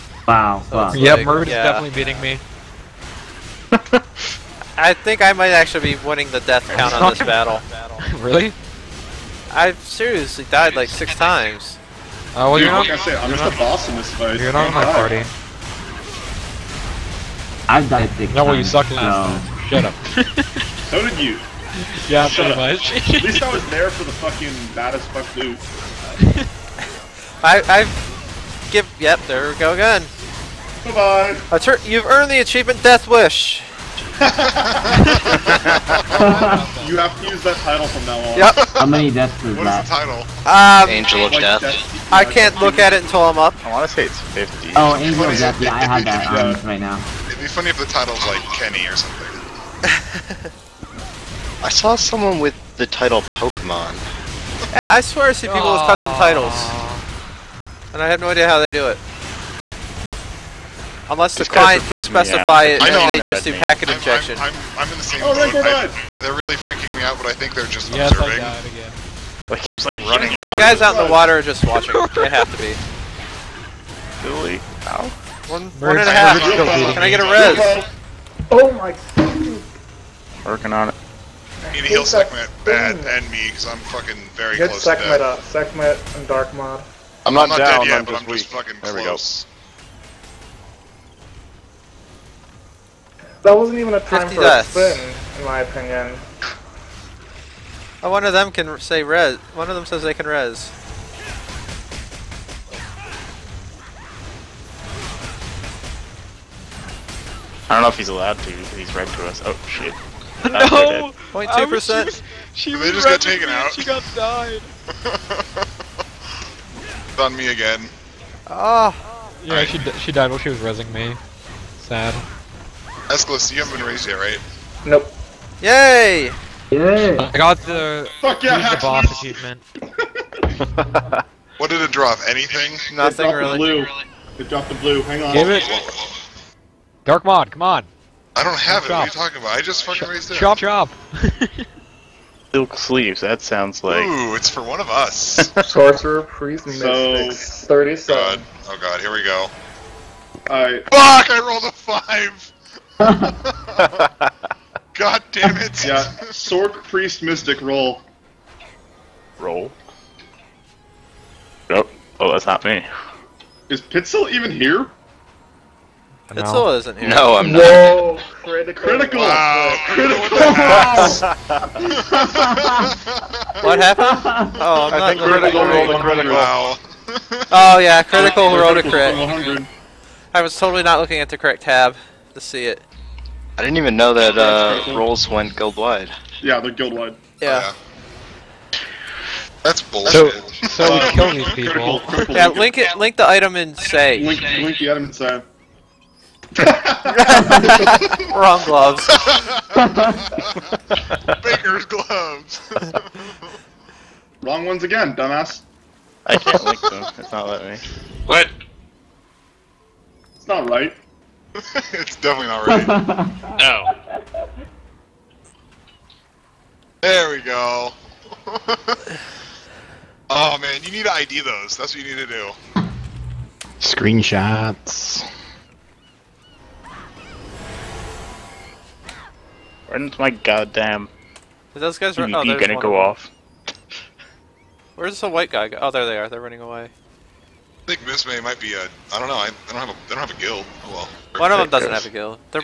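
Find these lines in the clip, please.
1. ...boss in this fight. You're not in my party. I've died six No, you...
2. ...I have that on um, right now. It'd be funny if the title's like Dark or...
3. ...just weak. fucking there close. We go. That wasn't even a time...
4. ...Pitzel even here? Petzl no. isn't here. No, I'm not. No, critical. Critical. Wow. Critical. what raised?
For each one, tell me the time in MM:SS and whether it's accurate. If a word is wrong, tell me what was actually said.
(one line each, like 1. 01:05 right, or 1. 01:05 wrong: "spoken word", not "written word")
1. 00:13 right
2. 00:45 wrong: "Kenny", not "Dark"
3. 01:28 right
4. 02:43 wrong: "happened", not "raised".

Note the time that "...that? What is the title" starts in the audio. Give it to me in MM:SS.
00:39.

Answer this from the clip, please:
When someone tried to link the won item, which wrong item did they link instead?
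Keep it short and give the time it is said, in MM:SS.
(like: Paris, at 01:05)
Baker's gloves, at 03:21.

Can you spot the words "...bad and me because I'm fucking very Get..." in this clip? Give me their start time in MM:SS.
01:22.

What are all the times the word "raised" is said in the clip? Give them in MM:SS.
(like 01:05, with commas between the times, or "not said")
02:03, 02:20.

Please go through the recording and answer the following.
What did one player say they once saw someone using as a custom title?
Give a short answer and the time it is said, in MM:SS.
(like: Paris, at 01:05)
Pokemon, at 00:53.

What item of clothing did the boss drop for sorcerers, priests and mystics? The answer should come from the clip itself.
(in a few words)
Silk sleeves.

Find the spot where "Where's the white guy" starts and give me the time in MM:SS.
03:54.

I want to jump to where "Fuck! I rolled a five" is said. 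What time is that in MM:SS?
02:30.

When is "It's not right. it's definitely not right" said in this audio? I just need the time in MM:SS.
03:30.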